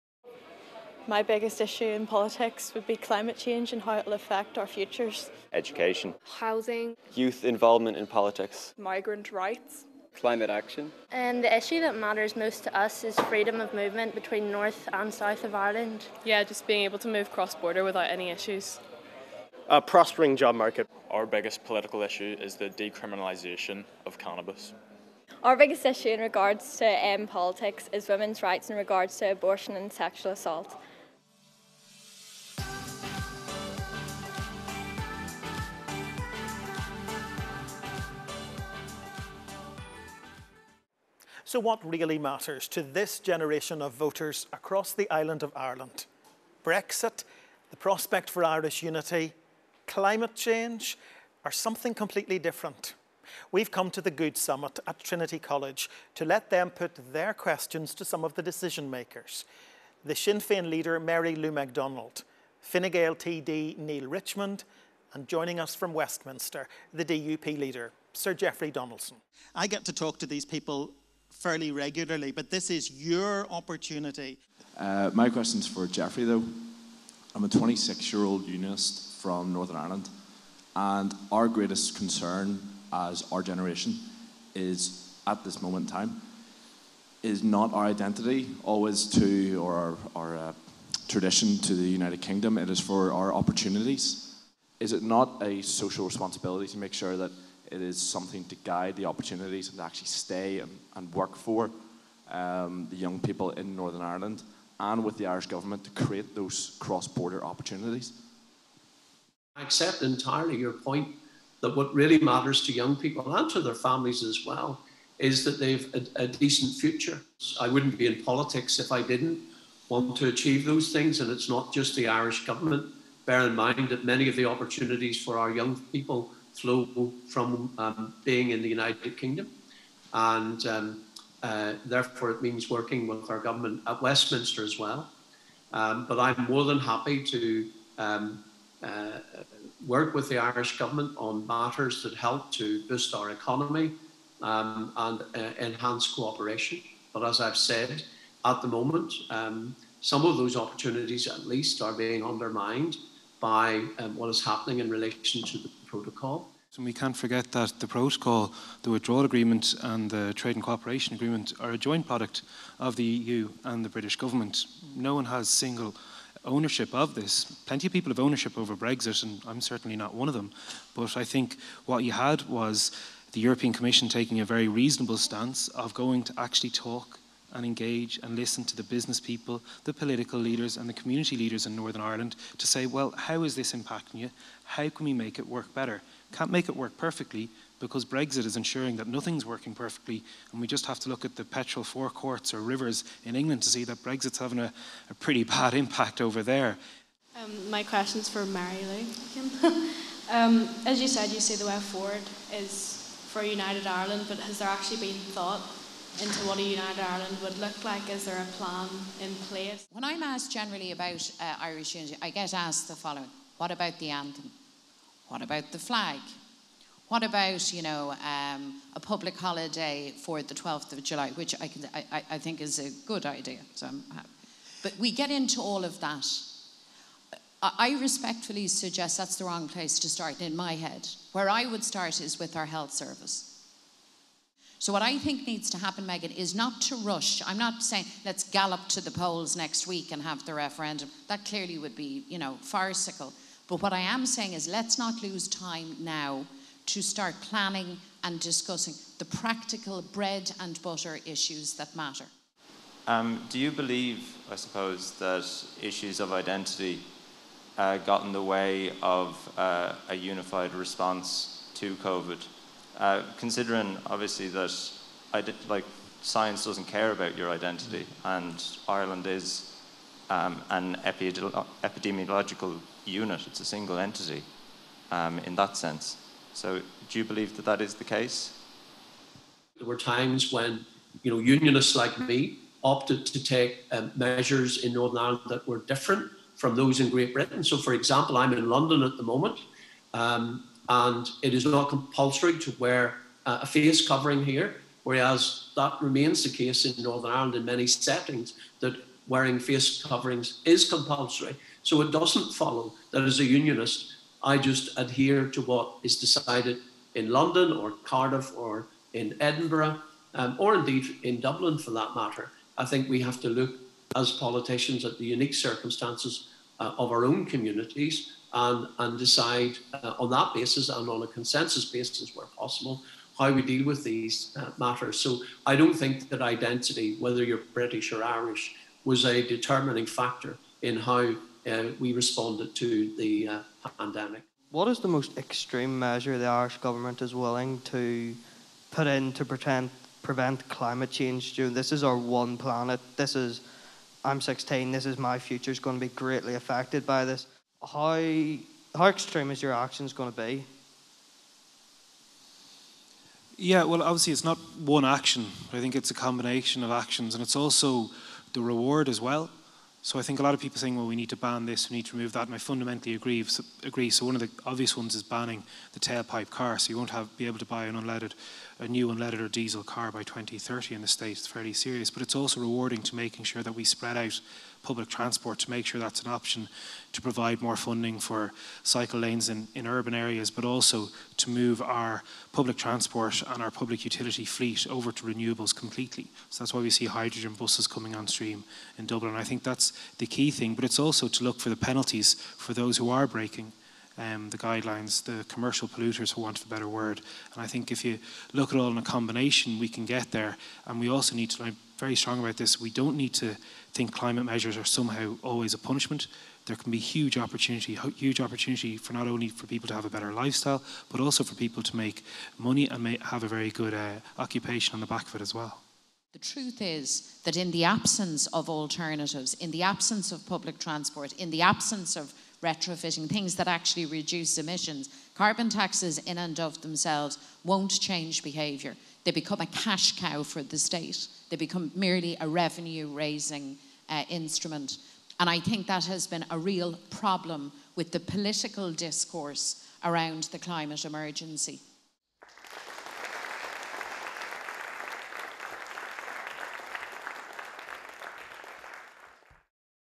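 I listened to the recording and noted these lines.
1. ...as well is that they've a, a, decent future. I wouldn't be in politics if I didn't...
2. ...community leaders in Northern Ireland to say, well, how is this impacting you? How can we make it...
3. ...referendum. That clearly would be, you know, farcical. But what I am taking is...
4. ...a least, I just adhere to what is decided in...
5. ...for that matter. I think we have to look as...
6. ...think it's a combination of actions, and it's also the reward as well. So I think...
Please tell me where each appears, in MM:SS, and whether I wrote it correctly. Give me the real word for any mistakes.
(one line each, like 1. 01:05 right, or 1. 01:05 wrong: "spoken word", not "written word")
1. 01:54 right
2. 03:00 right
3. 04:00 wrong: "saying", not "taking"
4. 05:03 wrong: "unionist", not "least"
5. 05:11 right
6. 05:55 right.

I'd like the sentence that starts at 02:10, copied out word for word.
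And um, uh, therefore, it means working with our government at Westminster as well.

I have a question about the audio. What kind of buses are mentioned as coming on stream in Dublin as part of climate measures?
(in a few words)
Hydrogen buses.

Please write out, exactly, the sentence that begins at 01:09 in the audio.
I get to talk to these people fairly regularly, but this is your opportunity.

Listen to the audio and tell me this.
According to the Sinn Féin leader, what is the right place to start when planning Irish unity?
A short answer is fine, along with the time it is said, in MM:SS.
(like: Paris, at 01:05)
Our health service, at 03:52.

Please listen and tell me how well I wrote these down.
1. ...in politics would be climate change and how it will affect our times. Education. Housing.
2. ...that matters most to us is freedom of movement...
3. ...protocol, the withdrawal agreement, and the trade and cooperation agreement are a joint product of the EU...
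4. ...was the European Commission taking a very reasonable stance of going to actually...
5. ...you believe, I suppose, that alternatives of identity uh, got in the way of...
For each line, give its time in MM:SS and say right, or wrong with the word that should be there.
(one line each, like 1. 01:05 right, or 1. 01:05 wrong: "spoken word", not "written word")
1. 00:01 wrong: "futures", not "times"
2. 00:11 right
3. 02:37 right
4. 02:52 right
5. 04:13 wrong: "issues", not "alternatives".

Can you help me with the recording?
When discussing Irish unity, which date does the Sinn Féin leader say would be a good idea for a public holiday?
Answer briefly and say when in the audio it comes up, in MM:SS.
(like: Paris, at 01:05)
12th of July, at 03:40.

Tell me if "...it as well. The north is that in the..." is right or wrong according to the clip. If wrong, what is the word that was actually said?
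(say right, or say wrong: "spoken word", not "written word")
wrong: "truth", not "north".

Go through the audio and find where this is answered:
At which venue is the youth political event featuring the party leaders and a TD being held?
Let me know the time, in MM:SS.
00:55.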